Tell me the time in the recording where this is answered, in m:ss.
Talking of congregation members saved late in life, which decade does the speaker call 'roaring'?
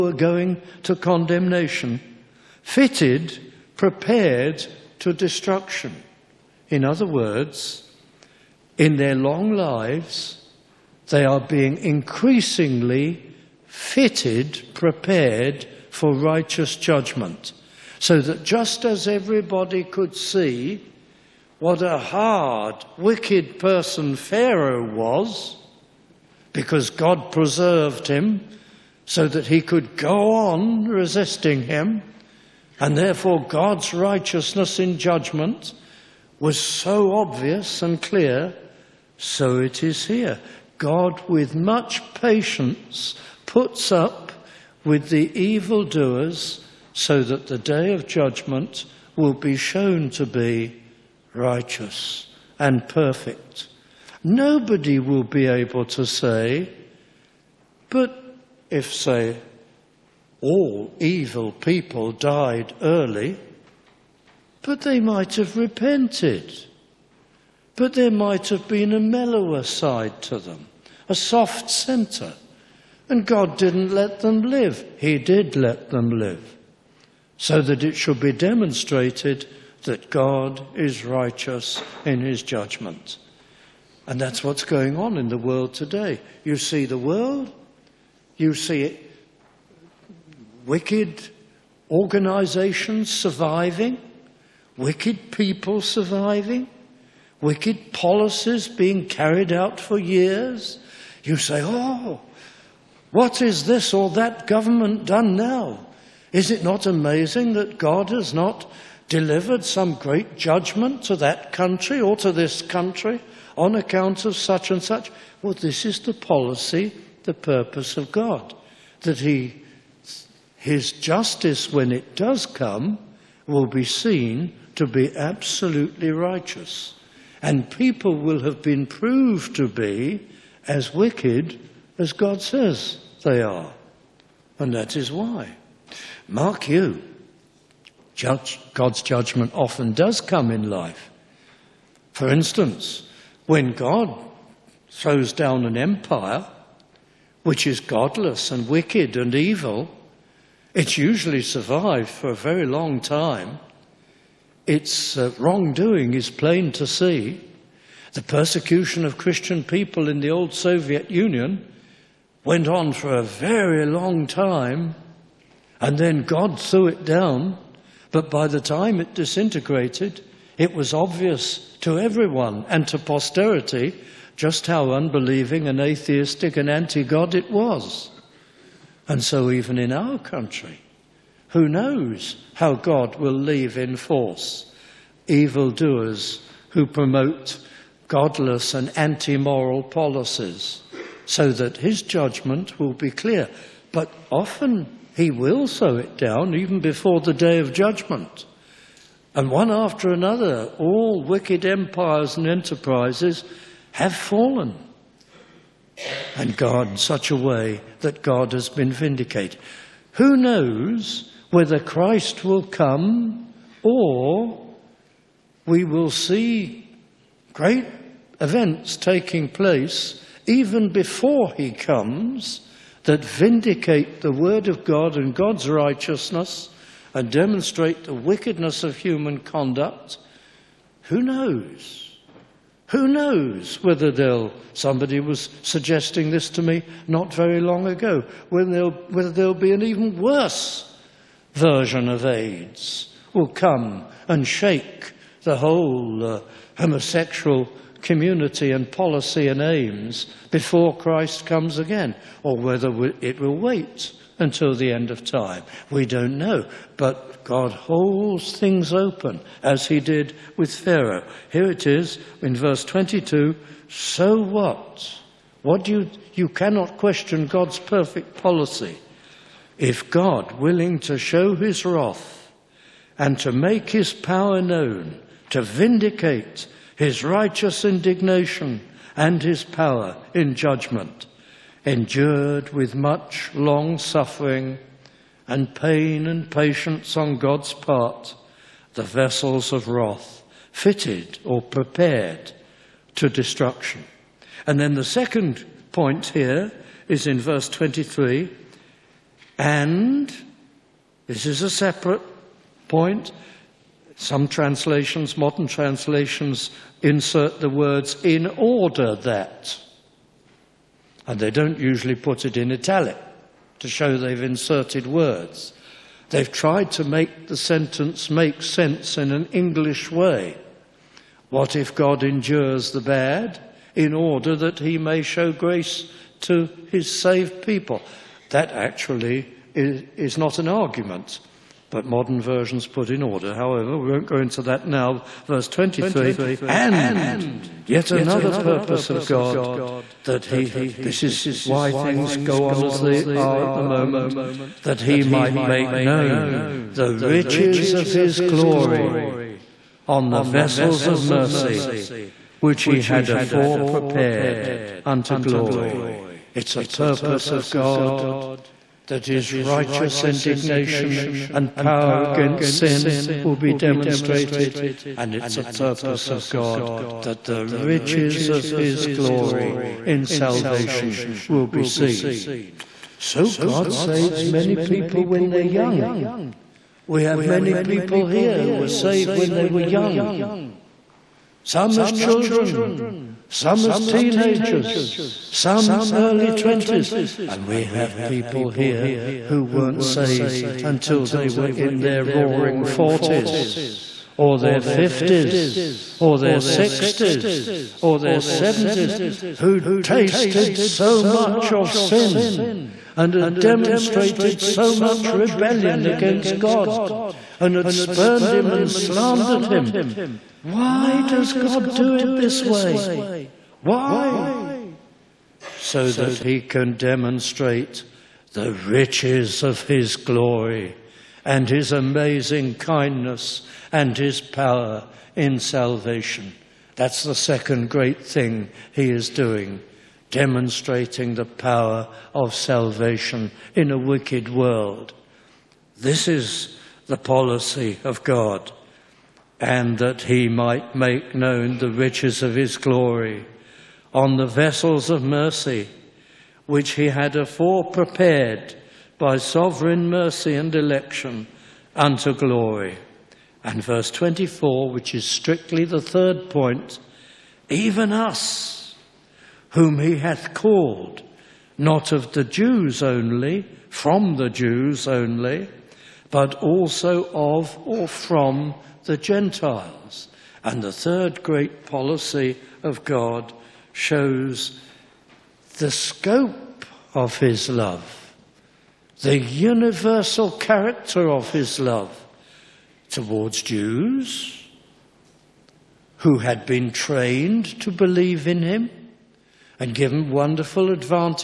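6:32.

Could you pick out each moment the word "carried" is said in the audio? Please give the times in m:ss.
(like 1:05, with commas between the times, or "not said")
1:39.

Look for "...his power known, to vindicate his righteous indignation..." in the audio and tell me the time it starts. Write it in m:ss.
4:33.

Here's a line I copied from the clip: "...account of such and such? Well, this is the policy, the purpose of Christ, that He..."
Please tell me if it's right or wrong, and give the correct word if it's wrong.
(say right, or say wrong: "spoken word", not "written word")
wrong: "God", not "Christ".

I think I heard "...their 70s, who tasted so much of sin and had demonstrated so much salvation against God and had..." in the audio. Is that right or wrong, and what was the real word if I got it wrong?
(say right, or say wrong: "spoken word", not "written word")
wrong: "rebellion", not "salvation".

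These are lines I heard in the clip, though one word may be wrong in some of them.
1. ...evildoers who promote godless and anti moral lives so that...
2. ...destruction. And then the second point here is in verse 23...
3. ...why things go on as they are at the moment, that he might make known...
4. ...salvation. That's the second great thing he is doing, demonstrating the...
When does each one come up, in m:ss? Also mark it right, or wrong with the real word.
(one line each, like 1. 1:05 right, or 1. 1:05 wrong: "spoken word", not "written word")
1. 3:05 wrong: "policies", not "lives"
2. 4:53 right
3. 5:41 right
4. 7:05 right.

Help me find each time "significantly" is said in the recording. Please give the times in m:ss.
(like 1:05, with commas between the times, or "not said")
not said.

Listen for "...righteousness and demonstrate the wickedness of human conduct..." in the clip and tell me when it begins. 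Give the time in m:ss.
3:45.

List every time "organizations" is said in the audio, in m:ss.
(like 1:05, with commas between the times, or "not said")
1:31.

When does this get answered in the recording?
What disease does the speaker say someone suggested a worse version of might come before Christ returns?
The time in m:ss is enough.
4:02.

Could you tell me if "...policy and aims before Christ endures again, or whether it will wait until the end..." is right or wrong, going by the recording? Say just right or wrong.
wrong.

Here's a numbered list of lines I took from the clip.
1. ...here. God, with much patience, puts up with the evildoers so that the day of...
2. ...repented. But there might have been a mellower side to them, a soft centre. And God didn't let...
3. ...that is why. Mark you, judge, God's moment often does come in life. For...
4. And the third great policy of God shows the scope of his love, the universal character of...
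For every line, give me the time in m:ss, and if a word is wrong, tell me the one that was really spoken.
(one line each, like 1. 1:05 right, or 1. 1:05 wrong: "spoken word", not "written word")
1. 0:40 right
2. 1:05 right
3. 2:14 wrong: "judgment", not "moment"
4. 7:50 right.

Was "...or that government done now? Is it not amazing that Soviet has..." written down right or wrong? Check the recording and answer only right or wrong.
wrong.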